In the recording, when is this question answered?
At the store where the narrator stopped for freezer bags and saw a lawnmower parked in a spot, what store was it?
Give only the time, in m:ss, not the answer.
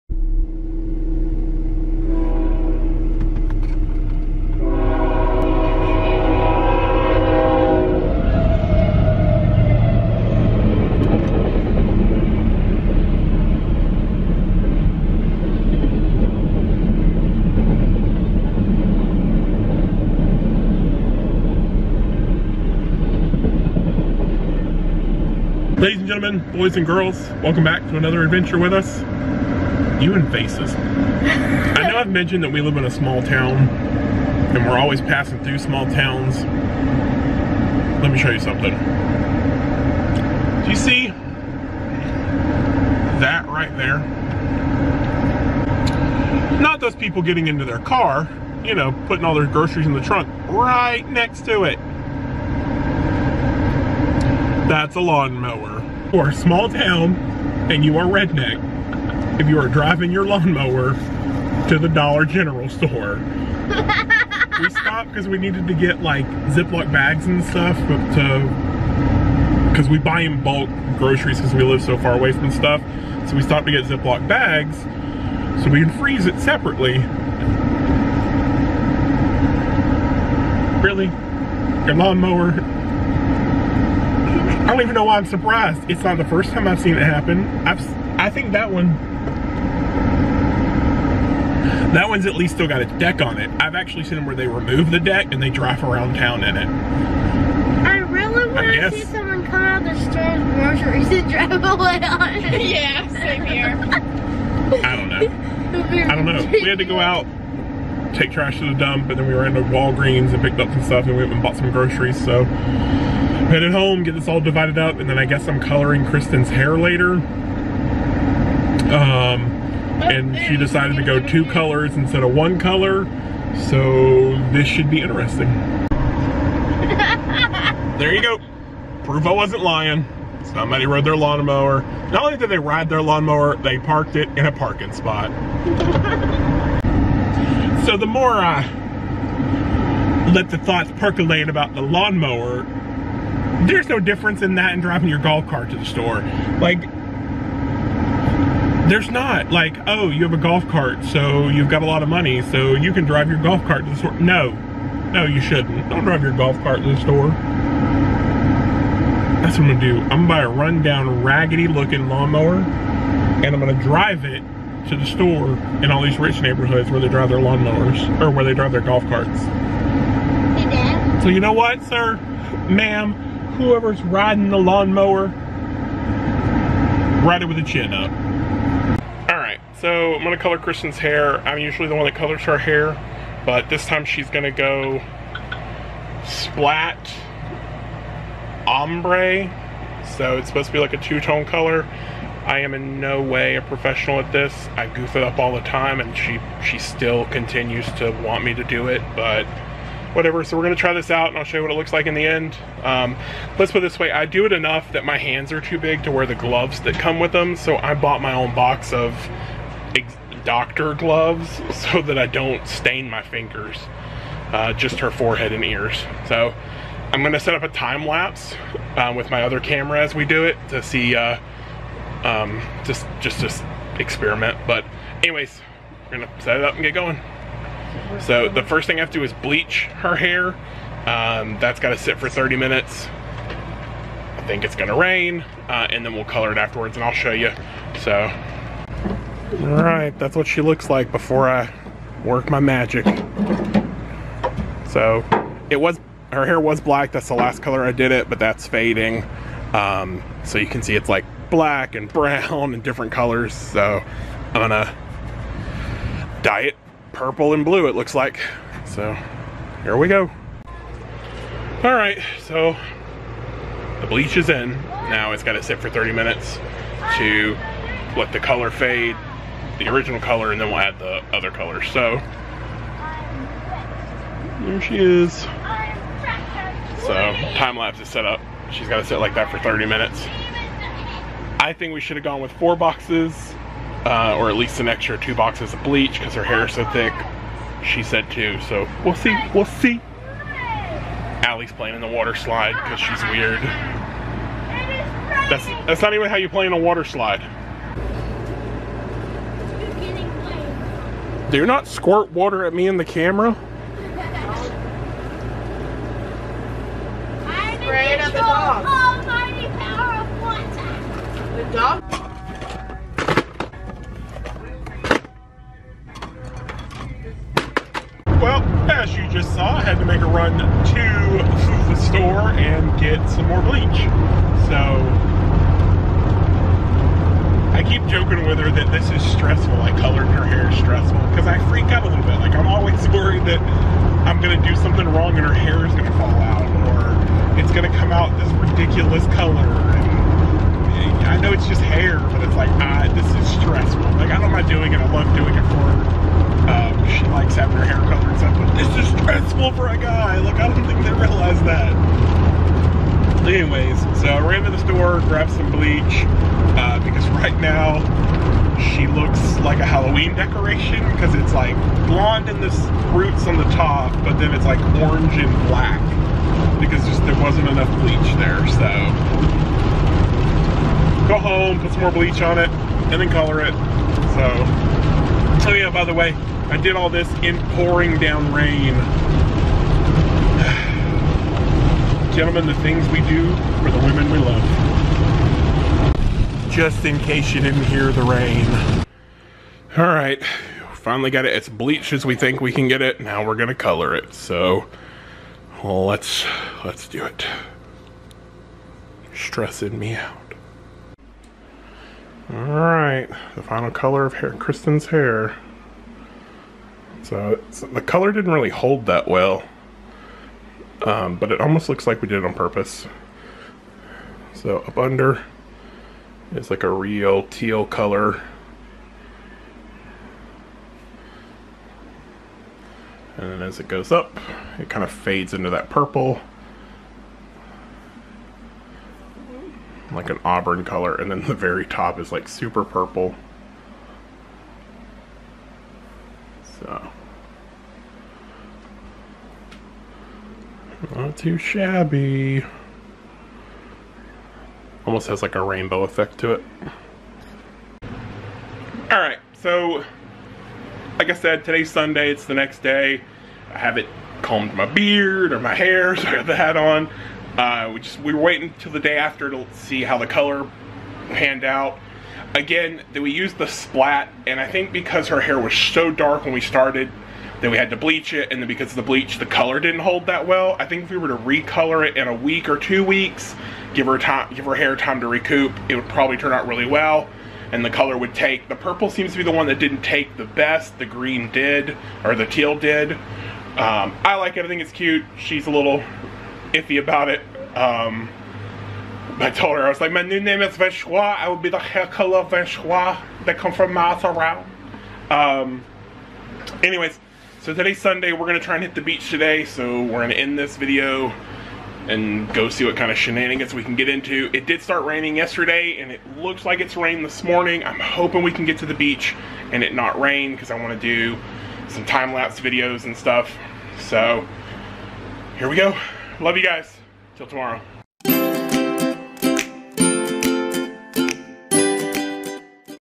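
1:01.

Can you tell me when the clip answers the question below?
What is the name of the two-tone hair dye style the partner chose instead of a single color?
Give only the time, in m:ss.
3:06.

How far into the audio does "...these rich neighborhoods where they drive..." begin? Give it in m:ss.
2:46.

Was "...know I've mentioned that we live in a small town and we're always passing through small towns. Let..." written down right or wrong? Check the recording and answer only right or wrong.
right.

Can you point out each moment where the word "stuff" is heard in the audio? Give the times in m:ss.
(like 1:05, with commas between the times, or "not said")
1:07, 1:12, 1:50, 8:33.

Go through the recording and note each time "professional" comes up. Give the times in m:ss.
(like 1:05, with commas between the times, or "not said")
3:13.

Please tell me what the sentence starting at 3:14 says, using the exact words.
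I goof it up all the time and she she still continues to want me to do it, but whatever.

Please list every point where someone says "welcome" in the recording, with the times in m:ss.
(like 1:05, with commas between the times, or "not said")
0:27.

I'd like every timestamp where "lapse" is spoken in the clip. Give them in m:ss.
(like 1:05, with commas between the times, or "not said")
3:38, 4:37, 8:32.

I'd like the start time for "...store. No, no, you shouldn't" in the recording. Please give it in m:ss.
2:33.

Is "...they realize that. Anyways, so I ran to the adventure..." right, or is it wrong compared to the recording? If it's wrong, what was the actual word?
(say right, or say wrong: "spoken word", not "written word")
wrong: "store", not "adventure".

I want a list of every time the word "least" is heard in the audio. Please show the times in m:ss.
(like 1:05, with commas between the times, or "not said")
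1:32, 4:44.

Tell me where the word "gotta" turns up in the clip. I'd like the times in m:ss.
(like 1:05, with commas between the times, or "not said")
3:51, 4:25, 4:38.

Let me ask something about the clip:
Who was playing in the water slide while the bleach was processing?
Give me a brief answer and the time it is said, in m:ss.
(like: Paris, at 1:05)
Allie, at 4:51.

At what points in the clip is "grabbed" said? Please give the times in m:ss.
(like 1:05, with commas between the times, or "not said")
5:55.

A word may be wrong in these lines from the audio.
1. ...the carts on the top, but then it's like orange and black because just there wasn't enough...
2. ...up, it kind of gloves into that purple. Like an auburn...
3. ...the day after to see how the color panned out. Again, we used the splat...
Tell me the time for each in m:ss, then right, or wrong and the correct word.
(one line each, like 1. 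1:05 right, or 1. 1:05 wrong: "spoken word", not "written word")
1. 6:02 wrong: "roots", not "carts"
2. 7:04 wrong: "fades", not "gloves"
3. 7:38 right.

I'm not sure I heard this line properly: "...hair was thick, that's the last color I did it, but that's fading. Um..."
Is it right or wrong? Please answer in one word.
wrong.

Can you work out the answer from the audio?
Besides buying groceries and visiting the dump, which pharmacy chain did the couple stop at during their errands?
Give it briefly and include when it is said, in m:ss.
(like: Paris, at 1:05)
Walgreens, at 1:49.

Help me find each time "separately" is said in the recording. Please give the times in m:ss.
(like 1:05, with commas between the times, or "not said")
1:16.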